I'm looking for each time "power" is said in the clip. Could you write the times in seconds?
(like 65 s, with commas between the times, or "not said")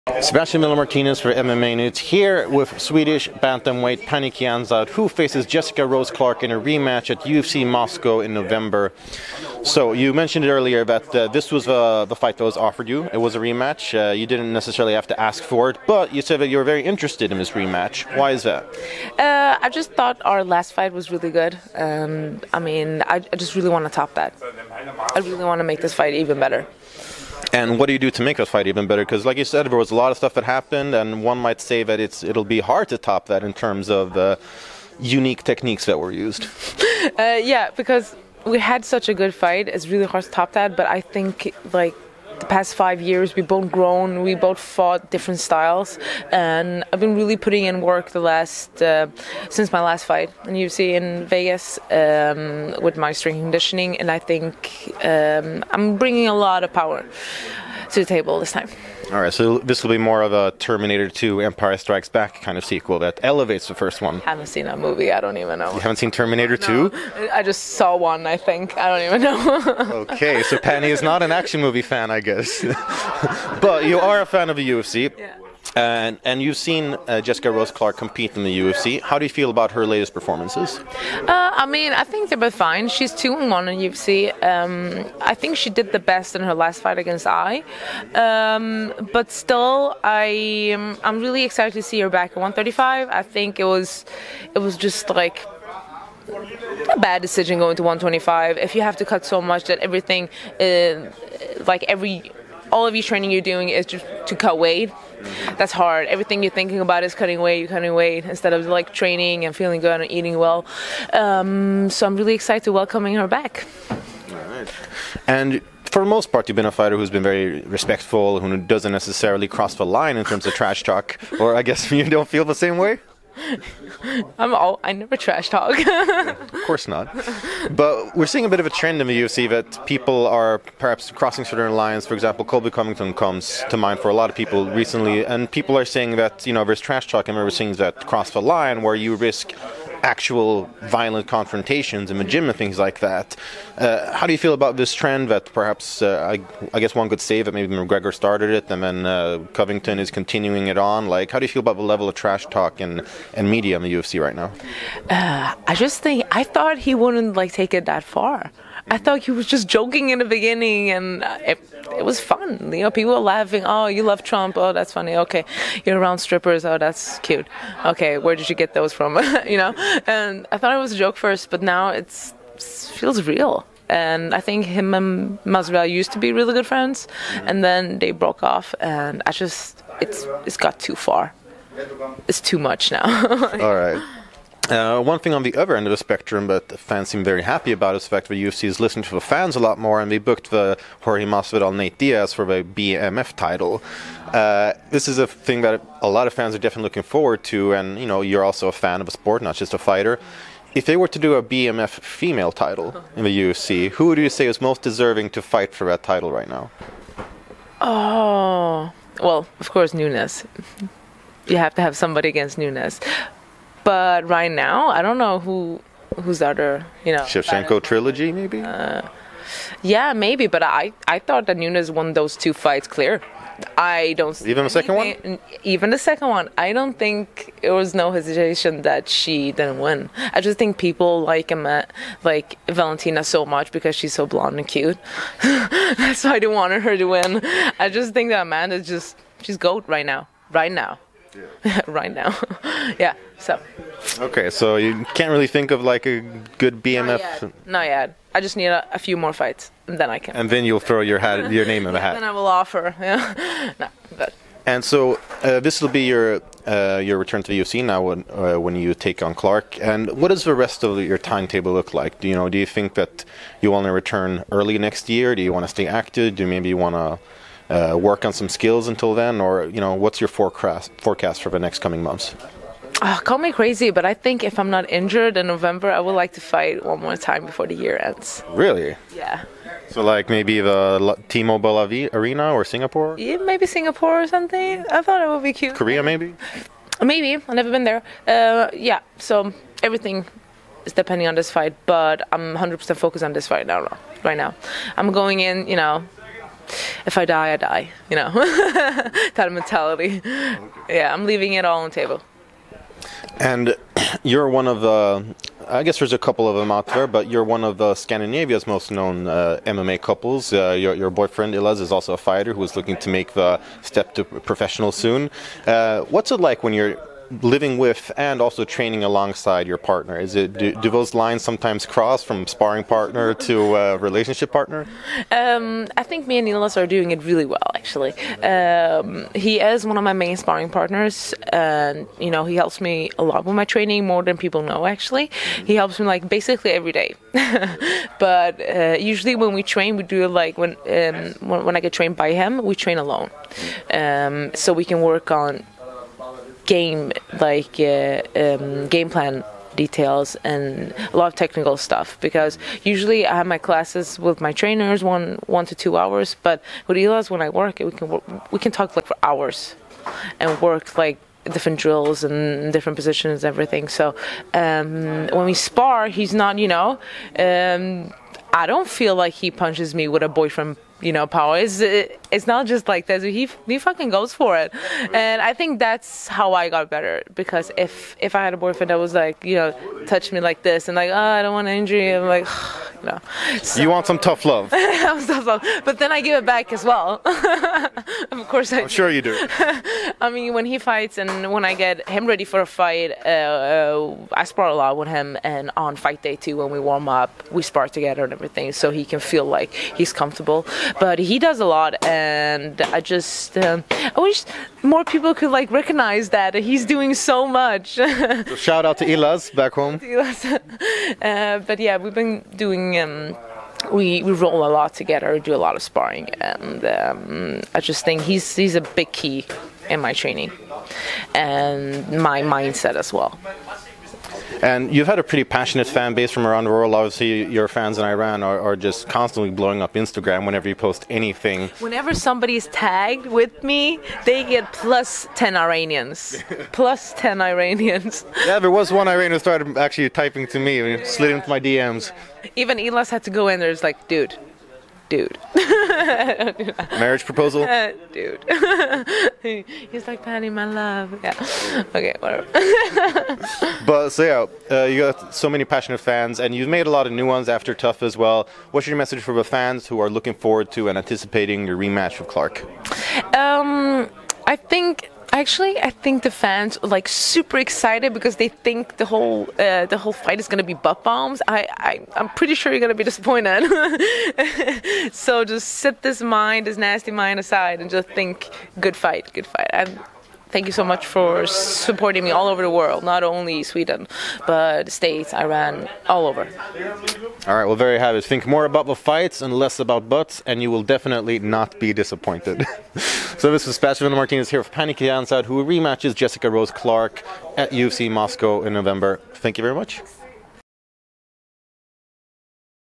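56 s, 371 s.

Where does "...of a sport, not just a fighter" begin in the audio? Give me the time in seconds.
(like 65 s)
199 s.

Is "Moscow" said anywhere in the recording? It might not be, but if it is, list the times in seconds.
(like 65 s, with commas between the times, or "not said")
7 s, 498 s.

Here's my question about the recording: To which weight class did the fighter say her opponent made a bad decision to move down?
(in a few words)
125.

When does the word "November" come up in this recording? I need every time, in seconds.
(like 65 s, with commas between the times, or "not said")
8 s, 275 s, 498 s.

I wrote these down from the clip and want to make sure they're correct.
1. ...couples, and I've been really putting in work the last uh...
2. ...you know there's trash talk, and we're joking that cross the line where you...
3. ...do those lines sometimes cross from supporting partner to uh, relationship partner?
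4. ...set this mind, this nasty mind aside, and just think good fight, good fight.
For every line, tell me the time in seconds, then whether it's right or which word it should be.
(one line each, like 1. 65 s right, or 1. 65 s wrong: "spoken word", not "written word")
1. 45 s wrong: "styles", not "couples"
2. 136 s wrong: "seeing", not "joking"
3. 320 s wrong: "sparring", not "supporting"
4. 475 s right.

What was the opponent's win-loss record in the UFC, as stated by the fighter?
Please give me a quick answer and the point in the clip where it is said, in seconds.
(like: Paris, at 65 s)
2 and 1, at 83 s.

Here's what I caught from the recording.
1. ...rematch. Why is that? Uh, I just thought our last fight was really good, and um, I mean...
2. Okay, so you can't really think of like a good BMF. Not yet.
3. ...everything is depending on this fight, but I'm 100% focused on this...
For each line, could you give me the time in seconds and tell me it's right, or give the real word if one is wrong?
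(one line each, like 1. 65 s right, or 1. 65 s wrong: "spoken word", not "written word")
1. 17 s right
2. 244 s right
3. 289 s right.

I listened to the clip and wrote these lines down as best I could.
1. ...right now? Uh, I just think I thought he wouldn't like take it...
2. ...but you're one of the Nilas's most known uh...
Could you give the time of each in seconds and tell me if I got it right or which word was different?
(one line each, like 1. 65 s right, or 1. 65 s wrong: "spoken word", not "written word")
1. 154 s right
2. 307 s wrong: "Scandinavia", not "Nilas".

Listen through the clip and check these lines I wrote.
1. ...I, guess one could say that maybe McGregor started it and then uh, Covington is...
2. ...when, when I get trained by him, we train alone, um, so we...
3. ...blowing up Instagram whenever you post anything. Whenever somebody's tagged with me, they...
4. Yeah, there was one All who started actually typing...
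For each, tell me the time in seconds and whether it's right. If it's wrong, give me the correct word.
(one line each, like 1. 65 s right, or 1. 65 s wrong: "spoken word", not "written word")
1. 146 s right
2. 341 s right
3. 429 s right
4. 438 s wrong: "Iranian", not "All".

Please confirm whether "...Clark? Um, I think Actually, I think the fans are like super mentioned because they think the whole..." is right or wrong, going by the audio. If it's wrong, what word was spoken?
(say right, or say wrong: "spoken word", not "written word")
wrong: "excited", not "mentioned".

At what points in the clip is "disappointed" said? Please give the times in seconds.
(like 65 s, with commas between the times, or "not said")
473 s, 491 s.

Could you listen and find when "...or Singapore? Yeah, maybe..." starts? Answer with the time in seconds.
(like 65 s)
282 s.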